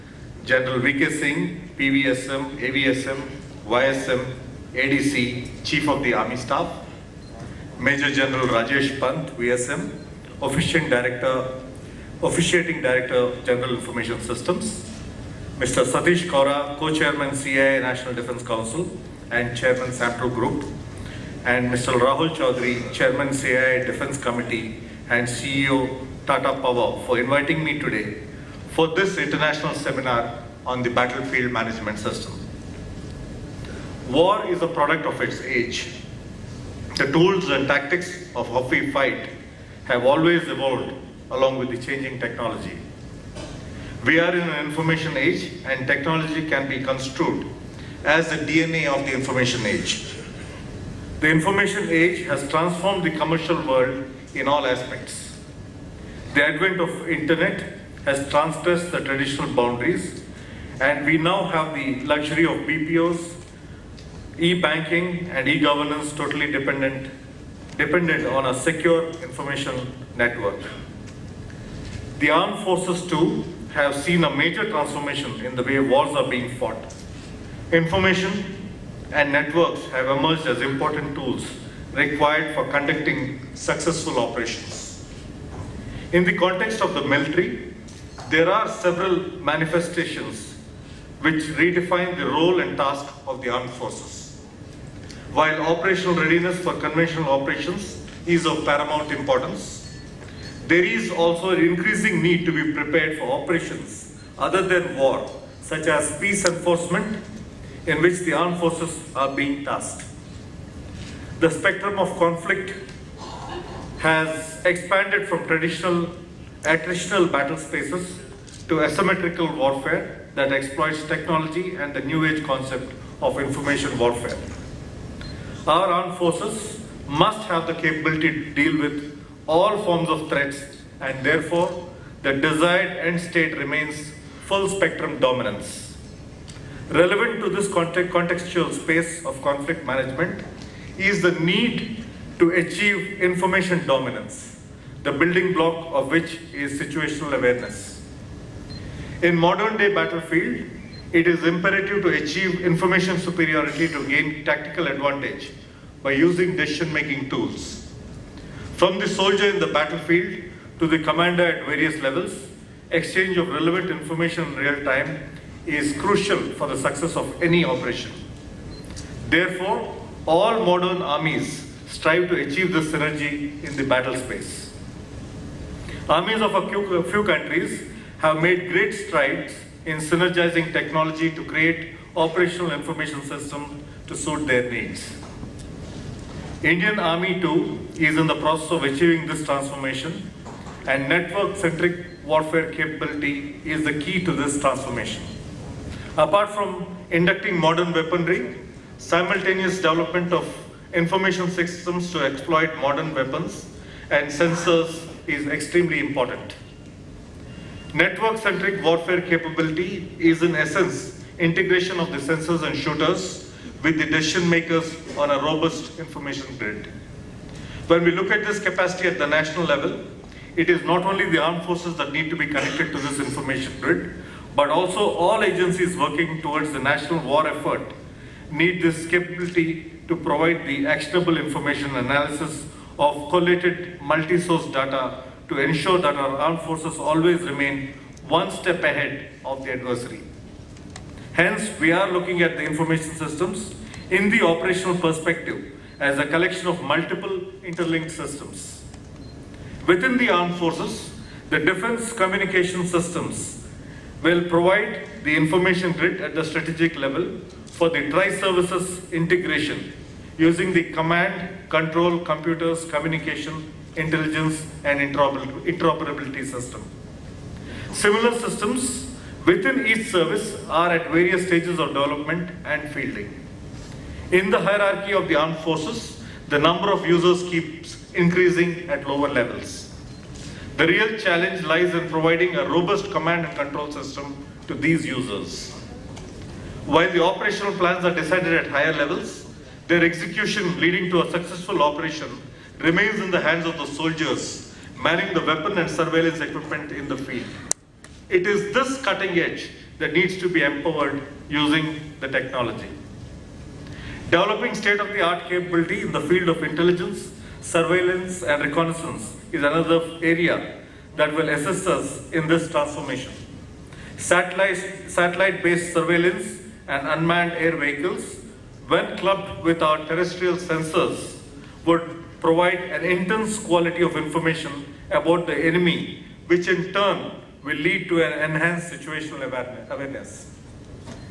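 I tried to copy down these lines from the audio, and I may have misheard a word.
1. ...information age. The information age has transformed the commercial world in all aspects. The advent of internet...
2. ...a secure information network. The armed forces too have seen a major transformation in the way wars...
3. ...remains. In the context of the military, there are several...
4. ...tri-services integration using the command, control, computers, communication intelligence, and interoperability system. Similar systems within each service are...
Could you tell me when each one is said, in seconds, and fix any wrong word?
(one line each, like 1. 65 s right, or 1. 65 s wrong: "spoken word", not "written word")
1. 49 s right
2. 68 s right
3. 84 s wrong: "operations", not "remains"
4. 258 s right.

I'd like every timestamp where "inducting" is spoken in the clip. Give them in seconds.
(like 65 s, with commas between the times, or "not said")
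197 s.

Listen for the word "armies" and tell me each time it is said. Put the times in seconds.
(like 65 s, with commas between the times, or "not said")
170 s, 176 s.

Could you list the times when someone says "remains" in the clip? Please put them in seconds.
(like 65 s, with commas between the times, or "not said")
133 s, 237 s, 292 s.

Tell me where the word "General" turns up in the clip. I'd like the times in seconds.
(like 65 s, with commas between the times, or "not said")
0 s, 8 s, 13 s.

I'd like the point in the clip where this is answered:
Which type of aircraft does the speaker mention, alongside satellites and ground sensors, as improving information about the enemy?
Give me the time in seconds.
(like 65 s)
317 s.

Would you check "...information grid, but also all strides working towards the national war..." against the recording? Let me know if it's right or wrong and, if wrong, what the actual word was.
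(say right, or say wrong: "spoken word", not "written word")
wrong: "agencies", not "strides".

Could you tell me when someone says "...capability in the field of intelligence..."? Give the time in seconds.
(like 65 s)
305 s.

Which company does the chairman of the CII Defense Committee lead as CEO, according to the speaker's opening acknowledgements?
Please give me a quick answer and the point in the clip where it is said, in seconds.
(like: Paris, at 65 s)
Tata Power, at 26 s.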